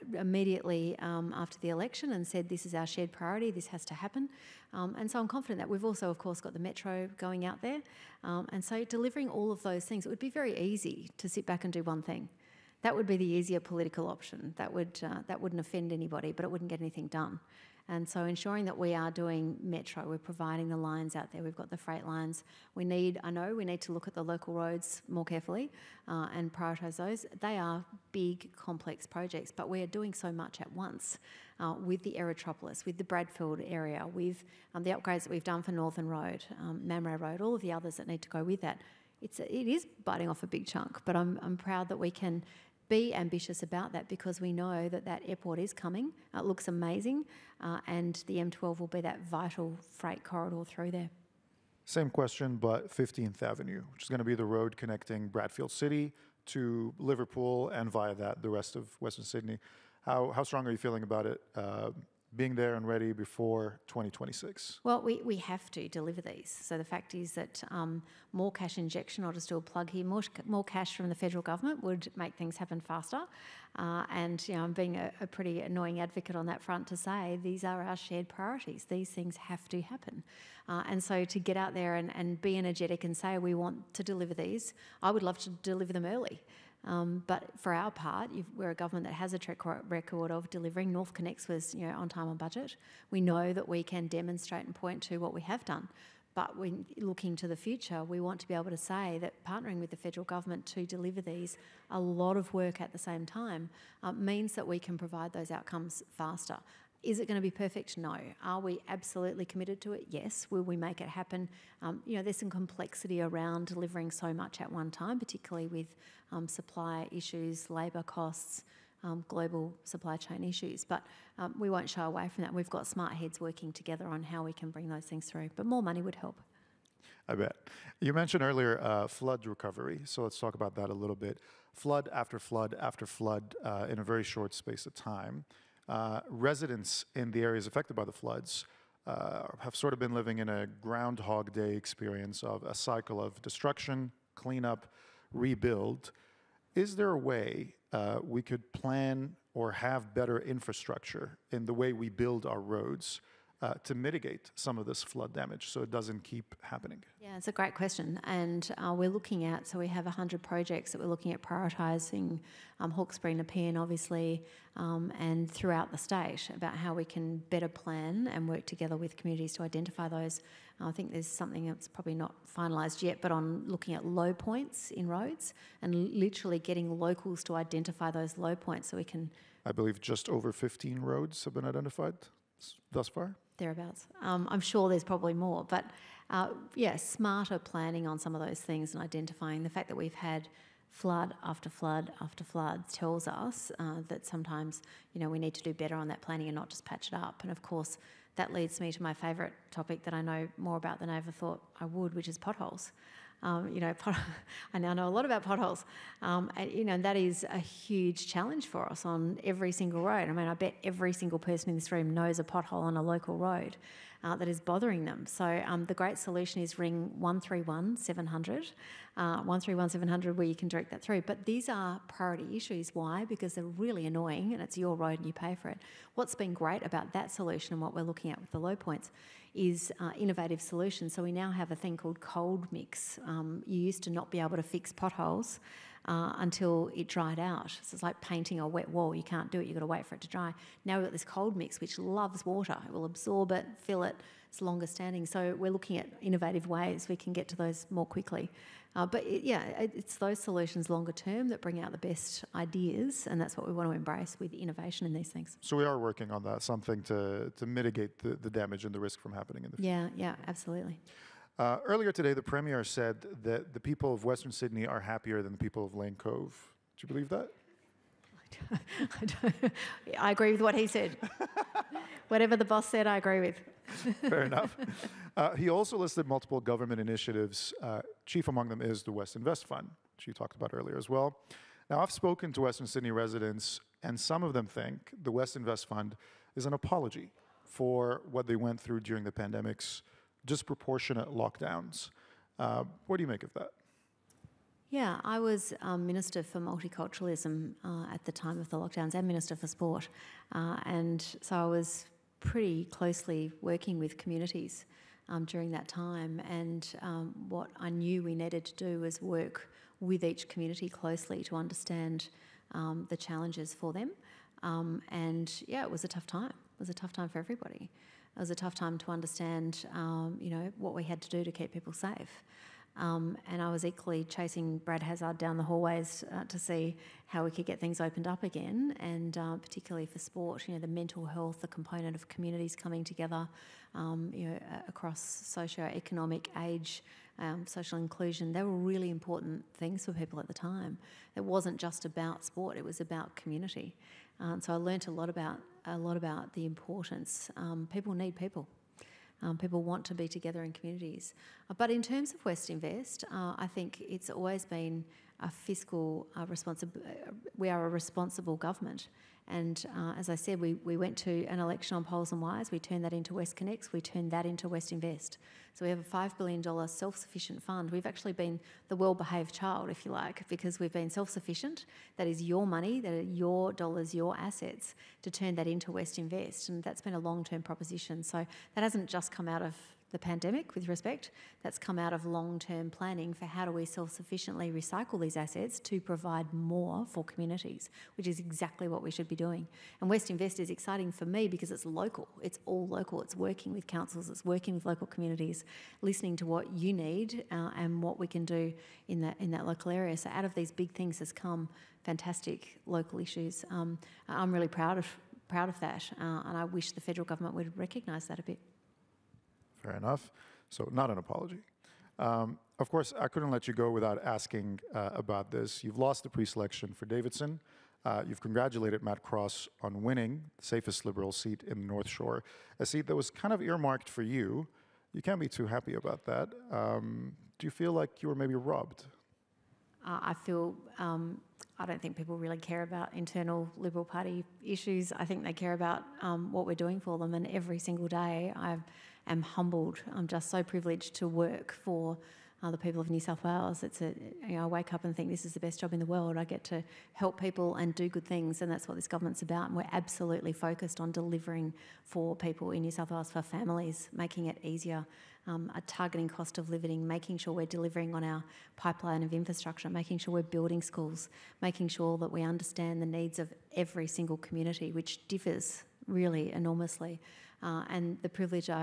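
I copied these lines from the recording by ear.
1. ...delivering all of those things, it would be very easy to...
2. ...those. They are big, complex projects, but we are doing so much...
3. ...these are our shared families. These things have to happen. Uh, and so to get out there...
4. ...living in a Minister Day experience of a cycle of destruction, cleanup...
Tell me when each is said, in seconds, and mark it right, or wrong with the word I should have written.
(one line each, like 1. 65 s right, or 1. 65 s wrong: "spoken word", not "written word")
1. 8 s right
2. 26 s right
3. 77 s wrong: "priorities", not "families"
4. 140 s wrong: "Groundhog", not "Minister".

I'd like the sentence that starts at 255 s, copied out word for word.
So we are working on that, something to, to mitigate the, the damage and the risk from happening in the future.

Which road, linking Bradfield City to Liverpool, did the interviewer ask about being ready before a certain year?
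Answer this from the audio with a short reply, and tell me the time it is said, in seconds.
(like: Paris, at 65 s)
15th Avenue, at 52 s.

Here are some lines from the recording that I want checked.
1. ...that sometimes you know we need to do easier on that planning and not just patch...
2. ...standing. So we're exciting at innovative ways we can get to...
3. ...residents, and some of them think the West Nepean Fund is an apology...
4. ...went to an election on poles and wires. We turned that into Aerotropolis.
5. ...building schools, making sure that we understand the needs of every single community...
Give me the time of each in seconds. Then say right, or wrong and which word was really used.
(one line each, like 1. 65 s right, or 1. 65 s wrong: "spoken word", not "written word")
1. 194 s wrong: "better", not "easier"
2. 244 s wrong: "looking", not "exciting"
3. 283 s wrong: "Invest", not "Nepean"
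4. 360 s wrong: "WestConnex", not "Aerotropolis"
5. 460 s right.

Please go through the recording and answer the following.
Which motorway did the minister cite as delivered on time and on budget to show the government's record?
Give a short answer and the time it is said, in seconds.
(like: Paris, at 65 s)
NorthConnex, at 90 s.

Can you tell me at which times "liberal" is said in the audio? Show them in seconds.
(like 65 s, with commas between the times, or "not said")
421 s, 433 s.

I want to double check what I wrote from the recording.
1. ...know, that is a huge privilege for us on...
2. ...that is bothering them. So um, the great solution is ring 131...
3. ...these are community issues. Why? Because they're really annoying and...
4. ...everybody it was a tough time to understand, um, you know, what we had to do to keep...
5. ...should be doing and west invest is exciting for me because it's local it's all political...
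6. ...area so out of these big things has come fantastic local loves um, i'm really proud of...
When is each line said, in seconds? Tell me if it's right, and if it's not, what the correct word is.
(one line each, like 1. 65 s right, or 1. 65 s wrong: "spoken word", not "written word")
1. 206 s wrong: "challenge", not "privilege"
2. 214 s right
3. 221 s wrong: "priority", not "community"
4. 317 s right
5. 389 s wrong: "local", not "political"
6. 399 s wrong: "issues", not "loves".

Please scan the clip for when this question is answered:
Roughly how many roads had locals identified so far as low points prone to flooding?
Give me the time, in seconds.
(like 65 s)
180 s.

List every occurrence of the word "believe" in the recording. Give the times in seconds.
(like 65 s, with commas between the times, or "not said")
179 s, 267 s.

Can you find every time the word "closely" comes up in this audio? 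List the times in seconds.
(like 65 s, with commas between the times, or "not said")
302 s, 310 s.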